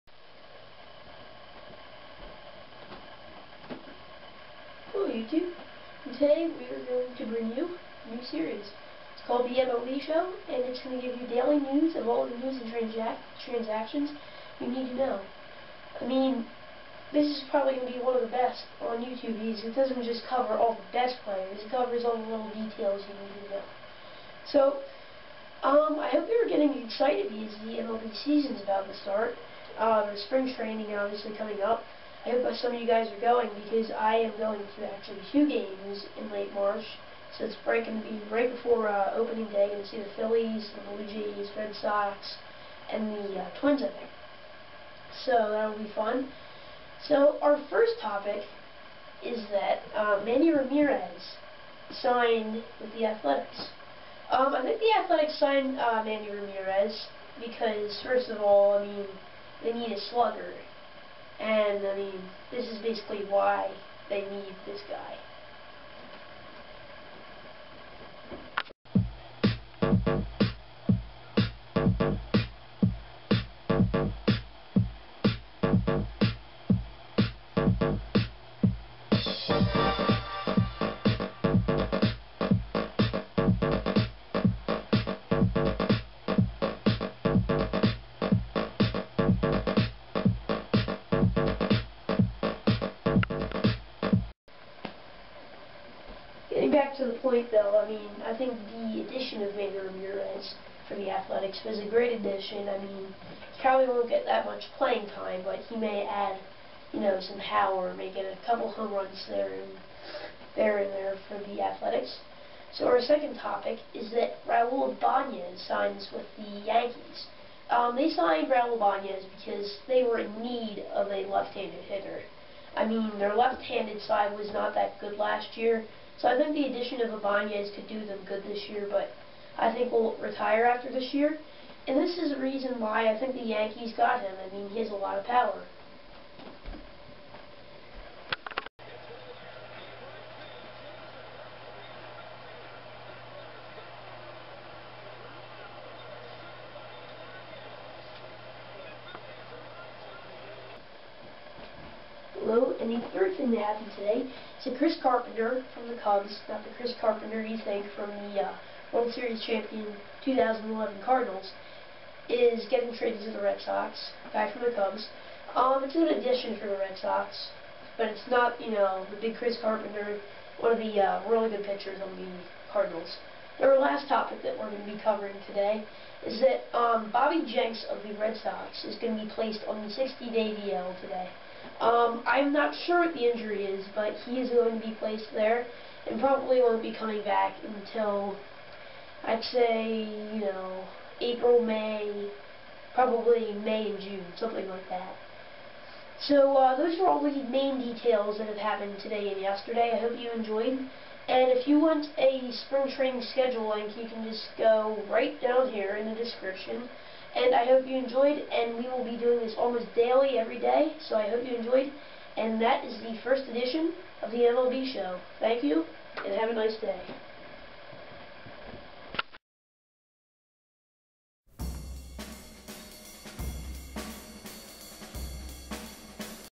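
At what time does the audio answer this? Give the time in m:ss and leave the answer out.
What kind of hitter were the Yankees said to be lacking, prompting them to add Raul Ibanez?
2:01.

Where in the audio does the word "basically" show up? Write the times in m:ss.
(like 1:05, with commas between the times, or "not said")
1:02.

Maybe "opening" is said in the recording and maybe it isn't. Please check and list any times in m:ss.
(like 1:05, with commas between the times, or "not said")
0:39.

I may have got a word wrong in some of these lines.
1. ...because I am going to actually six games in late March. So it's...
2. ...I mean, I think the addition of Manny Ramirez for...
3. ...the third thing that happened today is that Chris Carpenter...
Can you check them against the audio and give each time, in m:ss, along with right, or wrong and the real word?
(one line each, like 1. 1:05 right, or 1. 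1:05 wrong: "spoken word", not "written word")
1. 0:33 wrong: "two", not "six"
2. 1:37 right
3. 2:32 right.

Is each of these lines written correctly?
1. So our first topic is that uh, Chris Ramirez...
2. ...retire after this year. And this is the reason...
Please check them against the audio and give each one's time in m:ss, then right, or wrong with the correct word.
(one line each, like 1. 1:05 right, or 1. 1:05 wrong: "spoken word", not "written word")
1. 0:47 wrong: "Manny", not "Chris"
2. 2:10 right.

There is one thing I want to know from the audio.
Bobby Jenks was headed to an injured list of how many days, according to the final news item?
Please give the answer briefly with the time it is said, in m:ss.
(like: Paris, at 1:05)
60, at 2:59.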